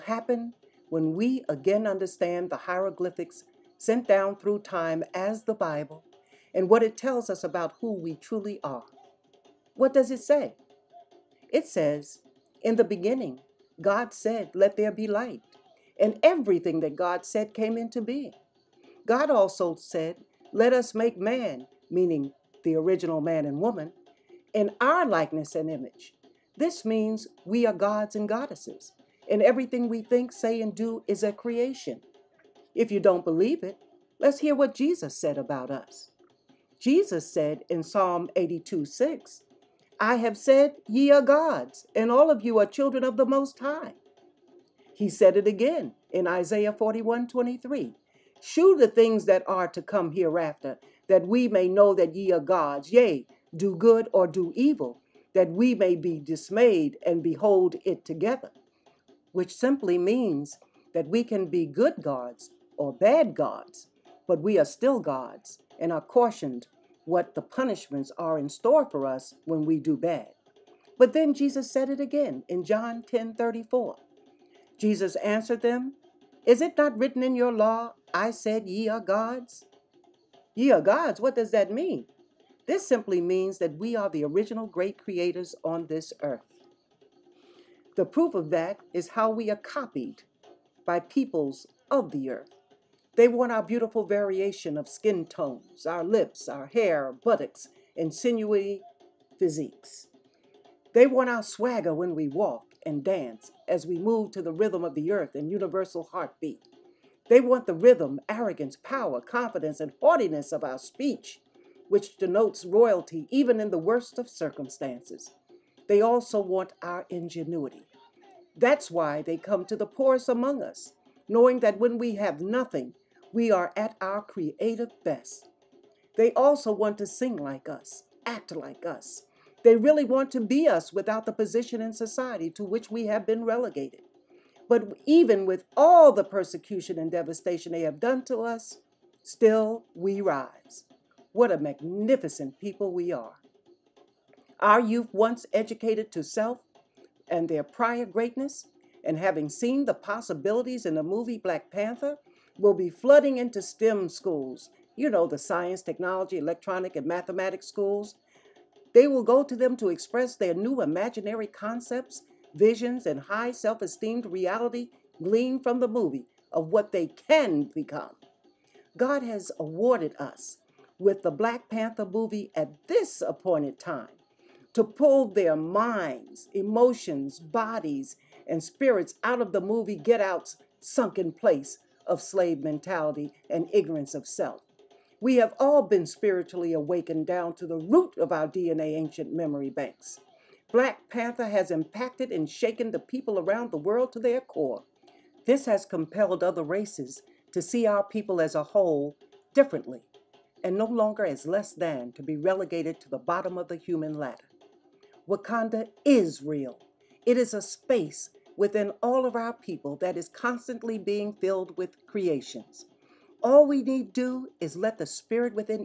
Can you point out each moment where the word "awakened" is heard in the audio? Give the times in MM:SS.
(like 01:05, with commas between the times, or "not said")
03:06.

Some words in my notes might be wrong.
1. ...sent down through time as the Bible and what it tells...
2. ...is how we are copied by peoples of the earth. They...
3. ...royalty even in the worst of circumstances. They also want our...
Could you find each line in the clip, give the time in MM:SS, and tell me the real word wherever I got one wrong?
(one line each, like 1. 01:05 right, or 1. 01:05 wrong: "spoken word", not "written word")
1. 00:03 right
2. 01:28 right
3. 01:52 right.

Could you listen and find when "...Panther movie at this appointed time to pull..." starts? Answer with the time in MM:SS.
02:51.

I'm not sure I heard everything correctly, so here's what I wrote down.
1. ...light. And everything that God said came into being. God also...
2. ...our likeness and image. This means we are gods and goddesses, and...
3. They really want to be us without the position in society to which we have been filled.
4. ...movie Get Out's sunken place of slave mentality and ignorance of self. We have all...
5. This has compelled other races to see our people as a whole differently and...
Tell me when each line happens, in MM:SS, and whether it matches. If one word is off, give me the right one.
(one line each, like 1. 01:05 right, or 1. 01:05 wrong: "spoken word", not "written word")
1. 00:15 right
2. 00:24 right
3. 02:09 wrong: "relegated", not "filled"
4. 02:59 right
5. 03:15 right.